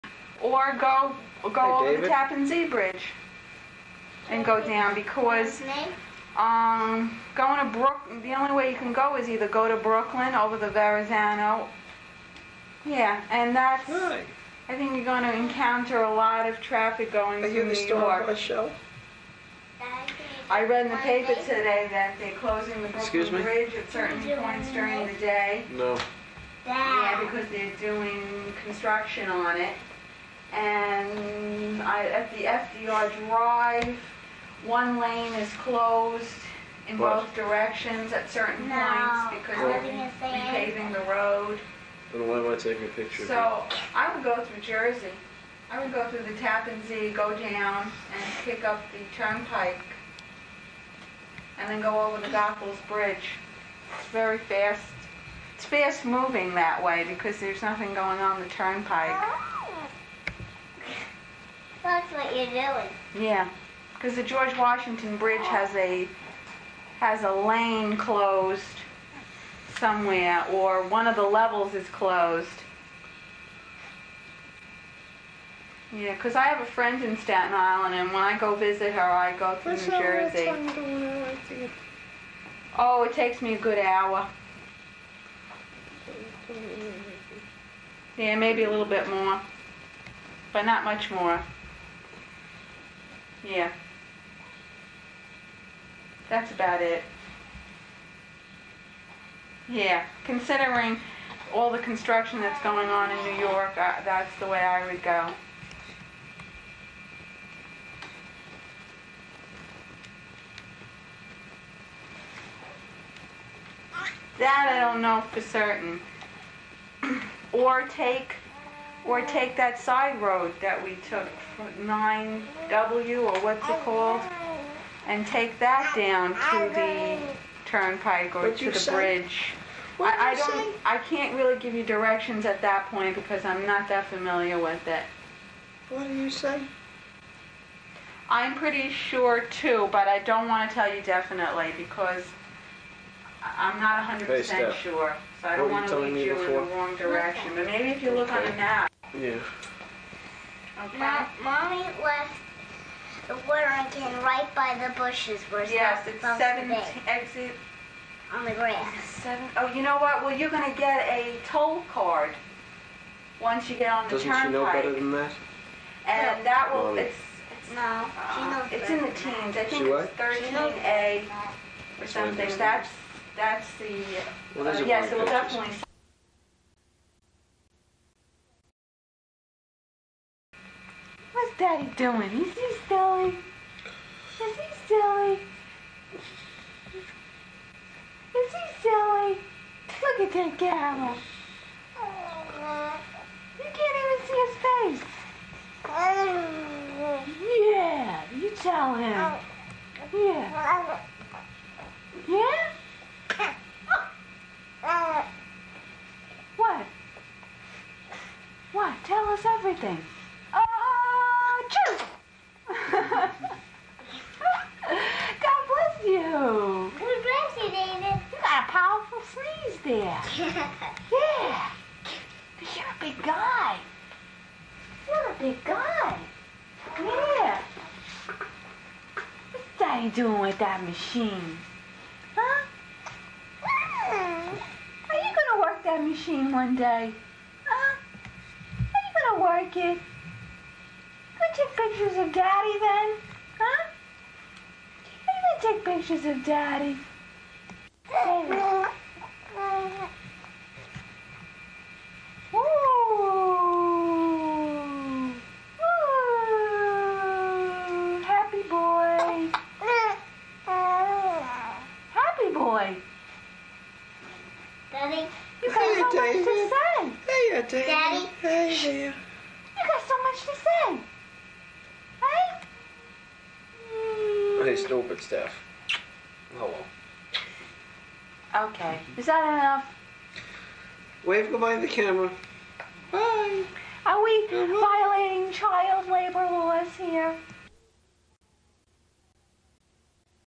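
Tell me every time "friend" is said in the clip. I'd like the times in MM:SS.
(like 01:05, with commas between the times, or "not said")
01:16.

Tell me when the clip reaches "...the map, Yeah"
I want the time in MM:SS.
02:28.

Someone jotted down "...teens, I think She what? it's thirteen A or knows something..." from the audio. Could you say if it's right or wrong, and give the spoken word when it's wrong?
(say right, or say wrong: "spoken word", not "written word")
right.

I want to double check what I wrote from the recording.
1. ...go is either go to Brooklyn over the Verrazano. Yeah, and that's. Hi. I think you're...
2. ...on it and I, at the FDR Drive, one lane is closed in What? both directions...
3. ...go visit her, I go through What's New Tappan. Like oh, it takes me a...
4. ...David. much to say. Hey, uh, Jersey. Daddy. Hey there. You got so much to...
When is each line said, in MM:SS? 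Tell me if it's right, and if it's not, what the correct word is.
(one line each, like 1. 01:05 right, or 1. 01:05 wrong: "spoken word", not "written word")
1. 00:08 right
2. 00:29 right
3. 01:18 wrong: "Jersey", not "Tappan"
4. 04:26 wrong: "David", not "Jersey".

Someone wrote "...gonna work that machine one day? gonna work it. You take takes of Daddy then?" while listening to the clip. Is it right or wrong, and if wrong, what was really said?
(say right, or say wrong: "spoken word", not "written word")
wrong: "pictures", not "takes".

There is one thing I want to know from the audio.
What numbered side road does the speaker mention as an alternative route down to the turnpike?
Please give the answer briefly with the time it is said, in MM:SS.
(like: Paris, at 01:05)
9W, at 02:01.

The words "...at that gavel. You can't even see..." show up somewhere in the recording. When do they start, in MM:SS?
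03:10.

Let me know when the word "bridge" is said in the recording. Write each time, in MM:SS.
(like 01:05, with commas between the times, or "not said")
00:02, 00:23, 00:52, 01:05, 02:08.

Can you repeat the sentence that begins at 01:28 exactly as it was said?
Yeah, maybe a little bit more, but not much more.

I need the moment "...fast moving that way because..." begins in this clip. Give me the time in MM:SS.
00:55.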